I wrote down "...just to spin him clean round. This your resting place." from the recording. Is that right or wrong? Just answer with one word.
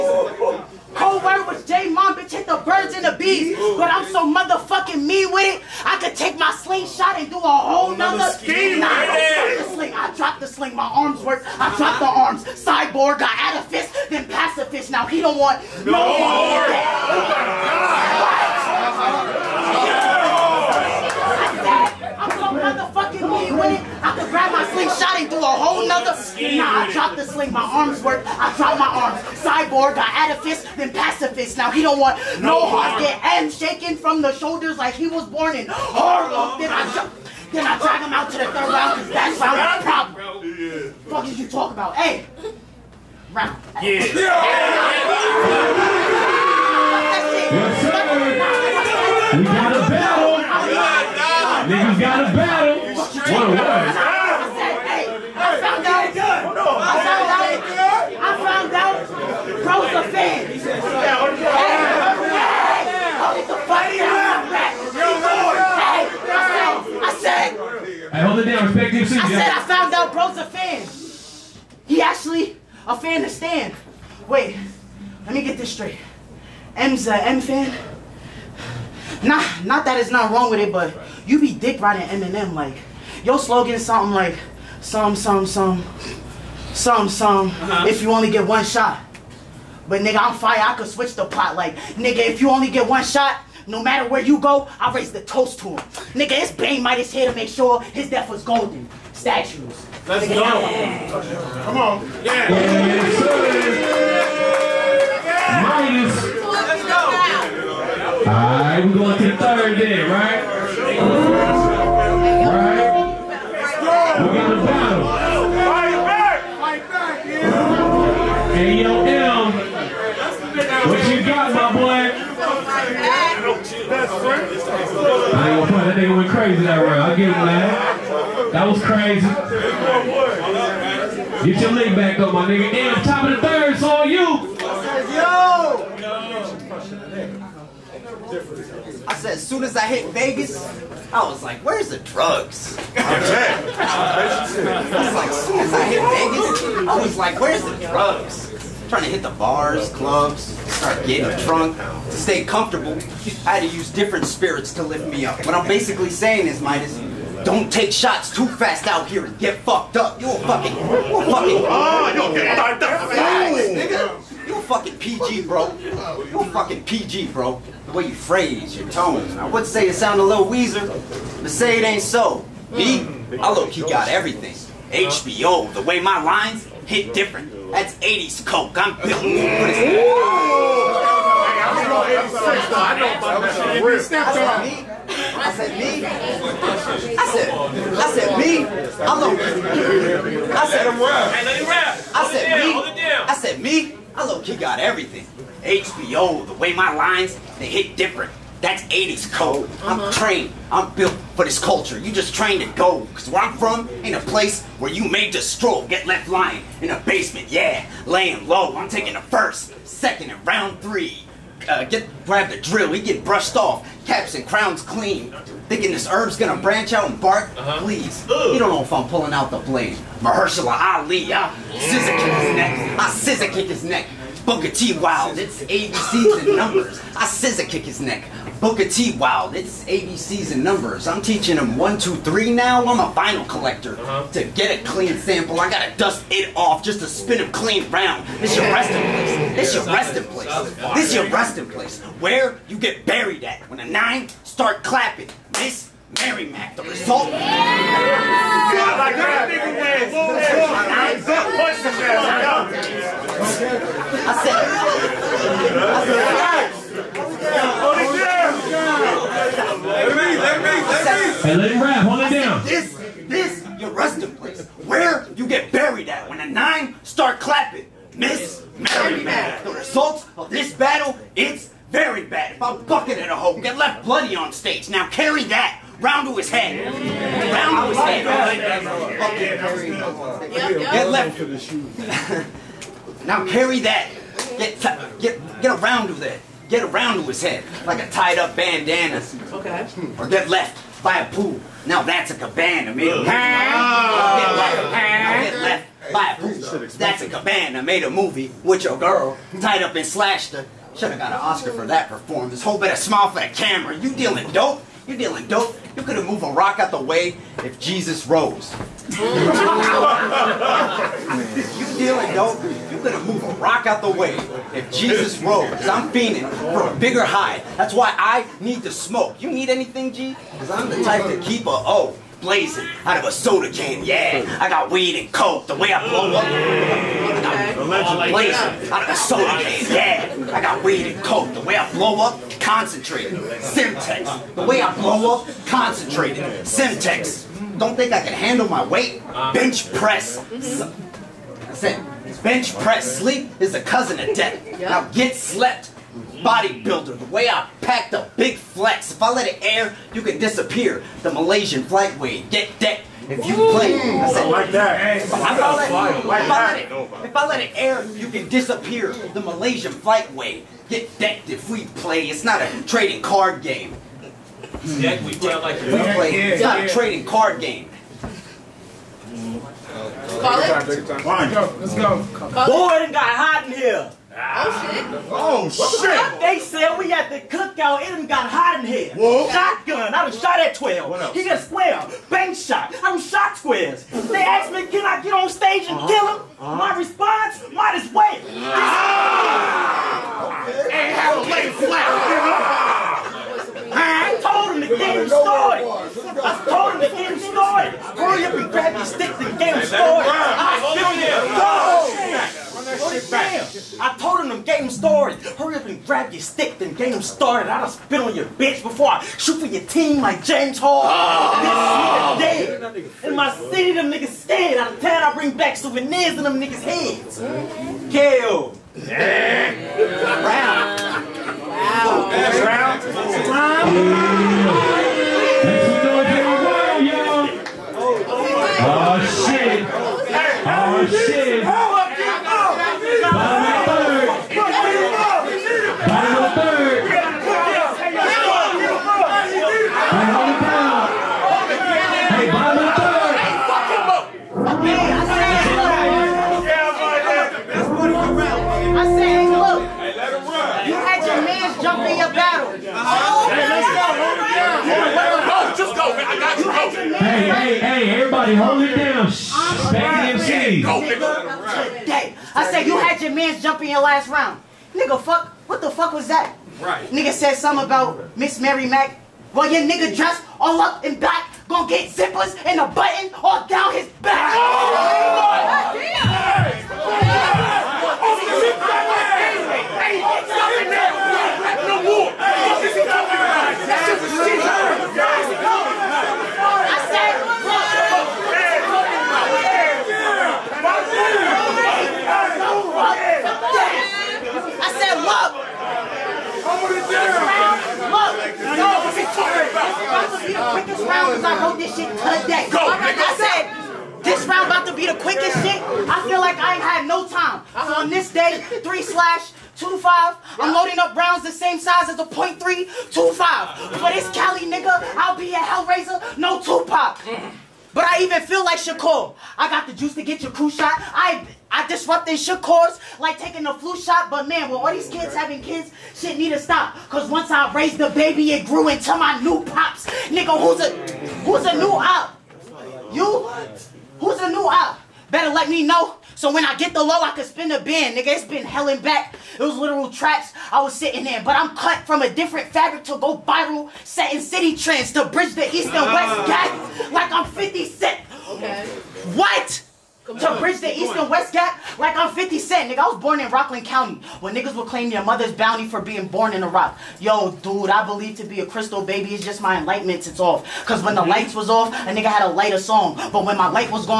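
right.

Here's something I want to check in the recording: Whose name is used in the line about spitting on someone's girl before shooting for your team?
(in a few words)
James Hall.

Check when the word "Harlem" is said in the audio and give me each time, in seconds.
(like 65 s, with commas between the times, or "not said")
35 s.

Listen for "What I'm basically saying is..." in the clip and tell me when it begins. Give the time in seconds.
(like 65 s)
155 s.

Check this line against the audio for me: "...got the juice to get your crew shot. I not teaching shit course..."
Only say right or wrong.
wrong.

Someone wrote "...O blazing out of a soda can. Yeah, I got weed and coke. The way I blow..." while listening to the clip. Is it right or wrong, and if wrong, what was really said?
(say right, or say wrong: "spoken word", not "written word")
right.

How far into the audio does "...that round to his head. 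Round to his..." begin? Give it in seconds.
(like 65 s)
275 s.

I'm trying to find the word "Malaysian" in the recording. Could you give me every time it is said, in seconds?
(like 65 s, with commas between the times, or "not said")
351 s, 359 s.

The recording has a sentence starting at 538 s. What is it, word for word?
Nigga, it's been hell and back.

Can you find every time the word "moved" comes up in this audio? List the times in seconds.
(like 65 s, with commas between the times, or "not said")
306 s, 313 s.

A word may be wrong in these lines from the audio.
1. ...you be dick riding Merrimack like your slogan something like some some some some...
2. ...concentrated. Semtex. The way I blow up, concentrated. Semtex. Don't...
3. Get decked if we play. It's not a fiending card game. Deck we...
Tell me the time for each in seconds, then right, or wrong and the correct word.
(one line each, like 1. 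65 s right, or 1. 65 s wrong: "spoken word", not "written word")
1. 81 s wrong: "Eminem", not "Merrimack"
2. 332 s right
3. 360 s wrong: "trading", not "fiending".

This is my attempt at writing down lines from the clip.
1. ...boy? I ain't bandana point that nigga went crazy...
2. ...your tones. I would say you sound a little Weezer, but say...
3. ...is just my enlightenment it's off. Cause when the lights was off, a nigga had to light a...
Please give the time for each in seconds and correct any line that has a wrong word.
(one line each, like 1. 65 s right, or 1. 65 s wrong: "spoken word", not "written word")
1. 121 s wrong: "gonna", not "bandana"
2. 168 s right
3. 559 s right.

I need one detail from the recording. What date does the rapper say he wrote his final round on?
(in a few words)
3/25.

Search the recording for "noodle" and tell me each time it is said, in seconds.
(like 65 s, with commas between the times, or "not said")
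not said.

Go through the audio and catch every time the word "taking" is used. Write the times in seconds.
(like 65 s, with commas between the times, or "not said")
208 s, 523 s.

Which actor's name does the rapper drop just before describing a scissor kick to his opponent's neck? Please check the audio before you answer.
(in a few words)
Mahershala Ali.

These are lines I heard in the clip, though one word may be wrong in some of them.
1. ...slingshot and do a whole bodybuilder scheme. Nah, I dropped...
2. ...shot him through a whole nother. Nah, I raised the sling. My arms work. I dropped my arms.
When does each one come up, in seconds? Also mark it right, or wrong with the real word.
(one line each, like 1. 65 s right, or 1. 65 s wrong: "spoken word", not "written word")
1. 6 s wrong: "nother", not "bodybuilder"
2. 24 s wrong: "dropped", not "raised".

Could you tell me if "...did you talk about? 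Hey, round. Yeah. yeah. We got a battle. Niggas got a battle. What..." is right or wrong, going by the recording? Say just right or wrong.
right.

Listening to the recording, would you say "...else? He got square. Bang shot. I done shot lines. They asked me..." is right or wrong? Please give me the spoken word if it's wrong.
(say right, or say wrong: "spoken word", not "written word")
wrong: "squares", not "lines".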